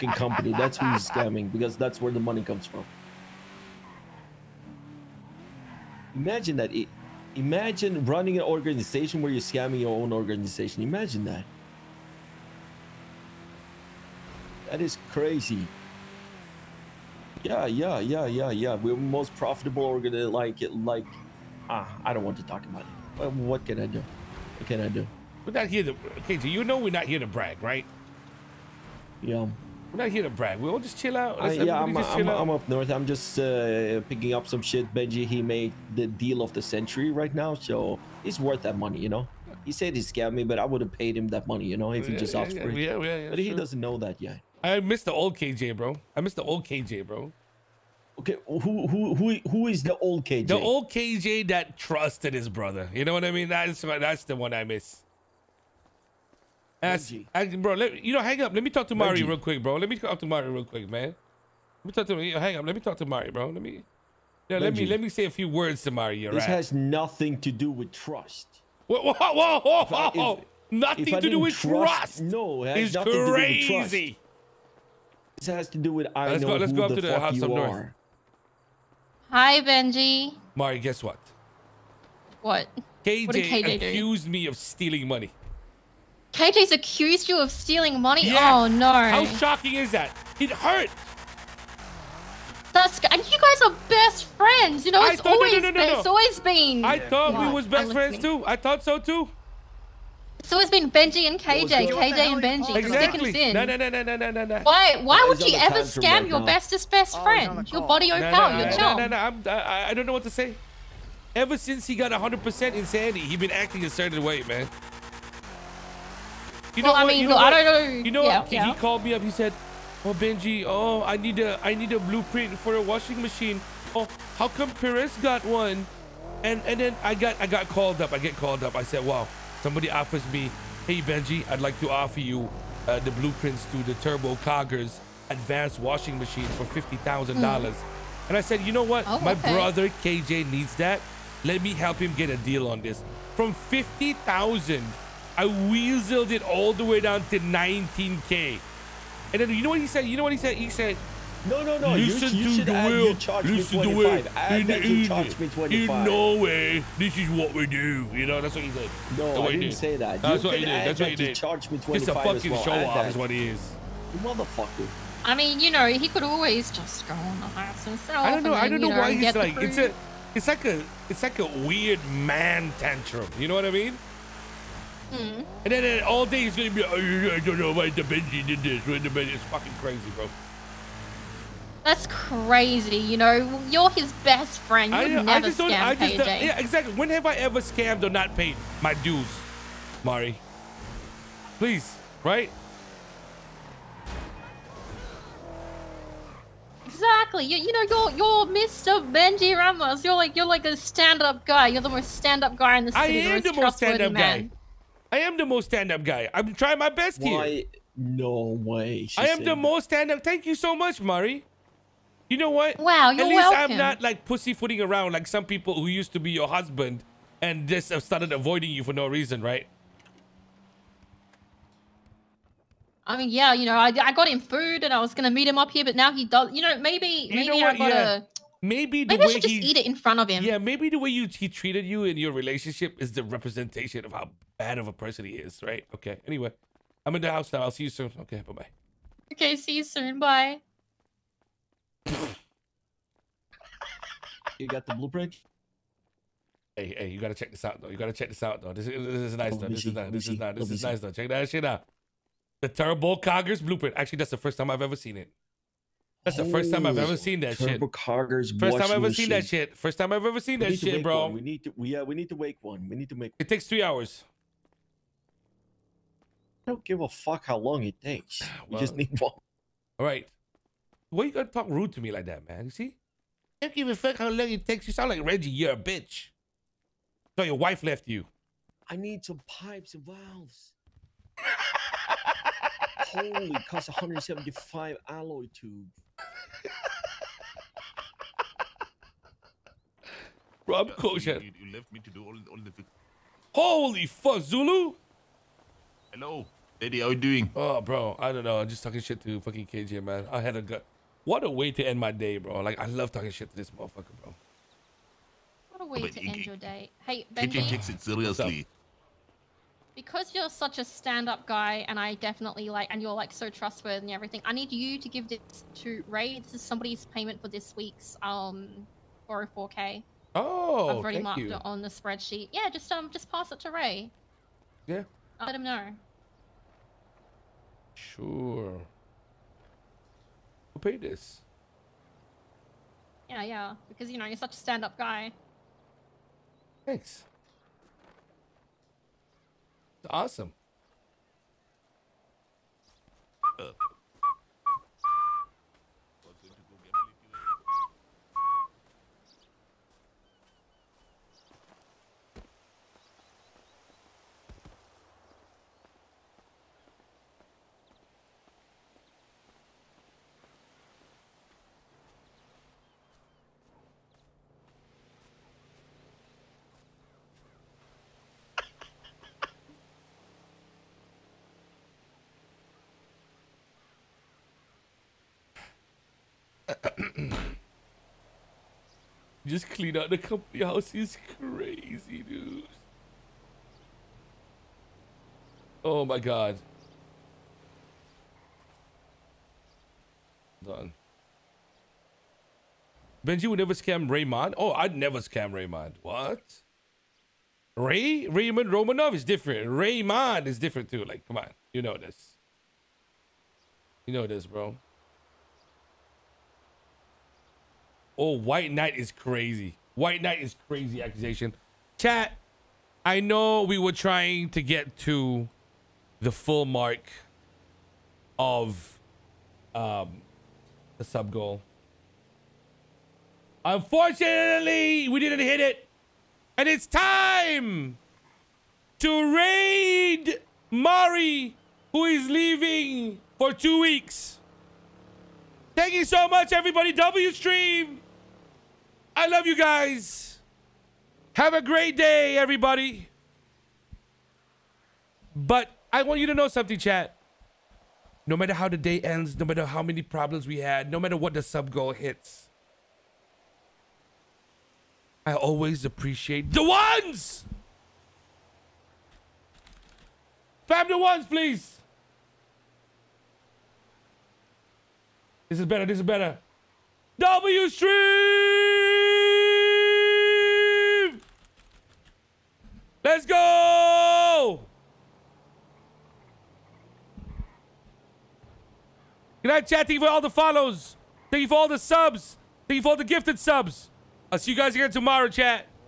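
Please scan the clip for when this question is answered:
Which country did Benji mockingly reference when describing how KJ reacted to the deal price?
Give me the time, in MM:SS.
02:36.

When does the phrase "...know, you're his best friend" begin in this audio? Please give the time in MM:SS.
03:03.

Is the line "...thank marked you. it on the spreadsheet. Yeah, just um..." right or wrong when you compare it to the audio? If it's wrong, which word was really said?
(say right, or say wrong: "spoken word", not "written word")
right.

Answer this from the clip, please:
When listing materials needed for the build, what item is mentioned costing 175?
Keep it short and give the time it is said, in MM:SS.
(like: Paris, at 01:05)
alloy tube, at 04:45.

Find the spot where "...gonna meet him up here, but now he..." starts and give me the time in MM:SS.
03:45.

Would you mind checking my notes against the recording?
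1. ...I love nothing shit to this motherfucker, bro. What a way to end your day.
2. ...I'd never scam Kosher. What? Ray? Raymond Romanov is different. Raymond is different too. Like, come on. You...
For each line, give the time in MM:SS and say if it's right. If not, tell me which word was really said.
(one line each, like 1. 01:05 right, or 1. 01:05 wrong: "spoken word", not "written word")
1. 05:02 wrong: "talking", not "nothing"
2. 06:34 wrong: "Raymond", not "Kosher".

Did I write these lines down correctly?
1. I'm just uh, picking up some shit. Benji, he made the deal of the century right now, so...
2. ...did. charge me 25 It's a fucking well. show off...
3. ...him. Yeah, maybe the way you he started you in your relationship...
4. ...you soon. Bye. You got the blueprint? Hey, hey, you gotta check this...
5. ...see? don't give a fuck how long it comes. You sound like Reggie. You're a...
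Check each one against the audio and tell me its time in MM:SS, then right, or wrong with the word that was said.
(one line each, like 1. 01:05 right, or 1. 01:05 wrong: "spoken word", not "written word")
1. 00:32 right
2. 02:41 right
3. 03:50 wrong: "treated", not "started"
4. 03:59 right
5. 04:32 wrong: "takes", not "comes".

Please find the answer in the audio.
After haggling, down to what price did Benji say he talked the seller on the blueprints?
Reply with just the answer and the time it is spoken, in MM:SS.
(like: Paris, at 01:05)
19K, at 02:27.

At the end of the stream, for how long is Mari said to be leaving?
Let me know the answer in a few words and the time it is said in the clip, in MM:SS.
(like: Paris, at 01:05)
2 weeks, at 07:13.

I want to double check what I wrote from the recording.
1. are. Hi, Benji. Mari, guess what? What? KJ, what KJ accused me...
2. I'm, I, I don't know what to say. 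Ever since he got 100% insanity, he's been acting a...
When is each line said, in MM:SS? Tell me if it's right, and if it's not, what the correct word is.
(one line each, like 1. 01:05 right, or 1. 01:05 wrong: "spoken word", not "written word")
1. 01:17 right
2. 01:49 right.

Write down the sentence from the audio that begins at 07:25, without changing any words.
But I want you to know something, chat.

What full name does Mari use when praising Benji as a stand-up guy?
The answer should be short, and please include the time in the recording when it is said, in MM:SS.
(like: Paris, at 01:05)
Benji Ramos, at 03:18.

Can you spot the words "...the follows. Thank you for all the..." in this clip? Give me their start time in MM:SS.
08:00.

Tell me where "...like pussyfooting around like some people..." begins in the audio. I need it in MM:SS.
03:34.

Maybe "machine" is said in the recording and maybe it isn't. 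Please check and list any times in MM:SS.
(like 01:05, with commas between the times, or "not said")
02:03, 02:16.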